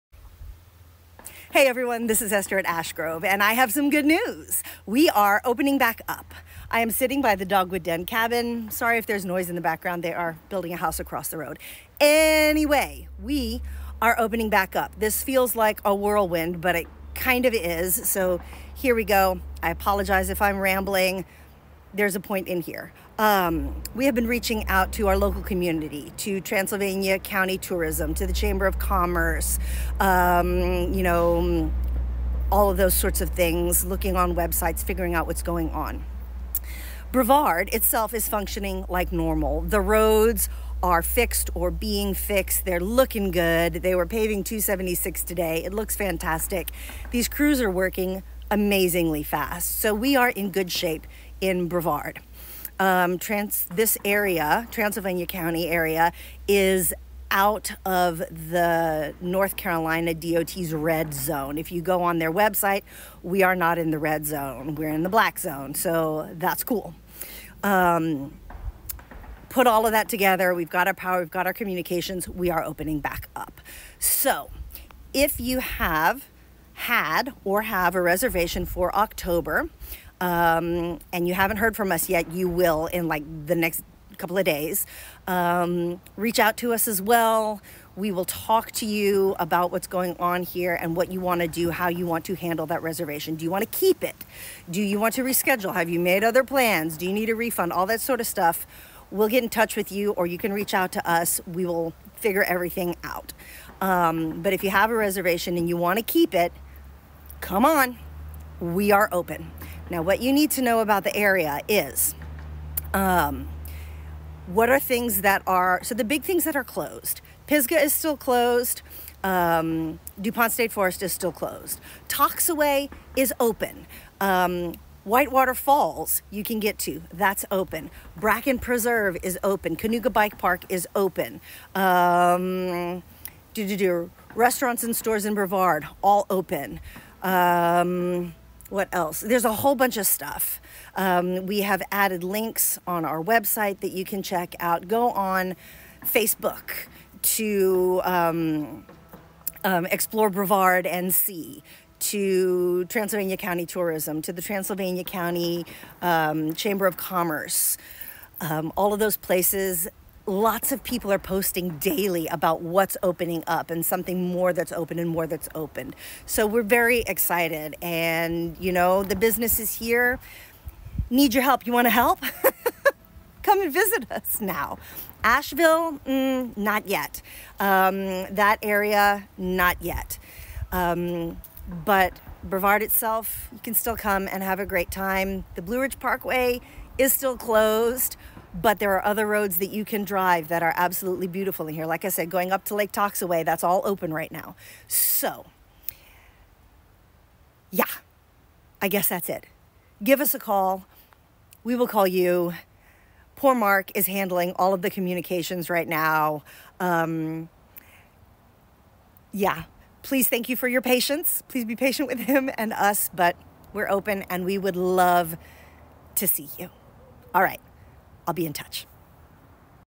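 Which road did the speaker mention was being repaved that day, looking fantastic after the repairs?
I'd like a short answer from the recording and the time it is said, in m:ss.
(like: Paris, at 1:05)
276, at 0:44.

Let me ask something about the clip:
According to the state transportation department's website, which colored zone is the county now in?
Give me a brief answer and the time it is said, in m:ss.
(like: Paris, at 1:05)
black zone, at 1:05.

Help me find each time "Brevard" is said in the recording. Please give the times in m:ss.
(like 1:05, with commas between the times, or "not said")
0:37, 0:51, 2:15, 2:30, 3:02.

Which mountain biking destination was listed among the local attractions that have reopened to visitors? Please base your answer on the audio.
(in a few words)
Kanuga Bike Park.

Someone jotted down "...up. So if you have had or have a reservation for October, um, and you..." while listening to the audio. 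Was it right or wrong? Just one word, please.
right.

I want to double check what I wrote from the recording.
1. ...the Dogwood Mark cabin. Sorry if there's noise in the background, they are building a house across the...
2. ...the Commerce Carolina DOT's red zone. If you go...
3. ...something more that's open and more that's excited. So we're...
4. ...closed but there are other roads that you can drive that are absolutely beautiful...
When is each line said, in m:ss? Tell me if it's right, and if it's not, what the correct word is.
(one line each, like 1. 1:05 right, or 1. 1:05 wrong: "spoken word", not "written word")
1. 0:07 wrong: "Den", not "Mark"
2. 0:58 wrong: "North", not "Commerce"
3. 2:43 wrong: "opened", not "excited"
4. 3:07 right.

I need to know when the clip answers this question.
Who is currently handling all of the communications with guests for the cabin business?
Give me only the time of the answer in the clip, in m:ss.
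3:23.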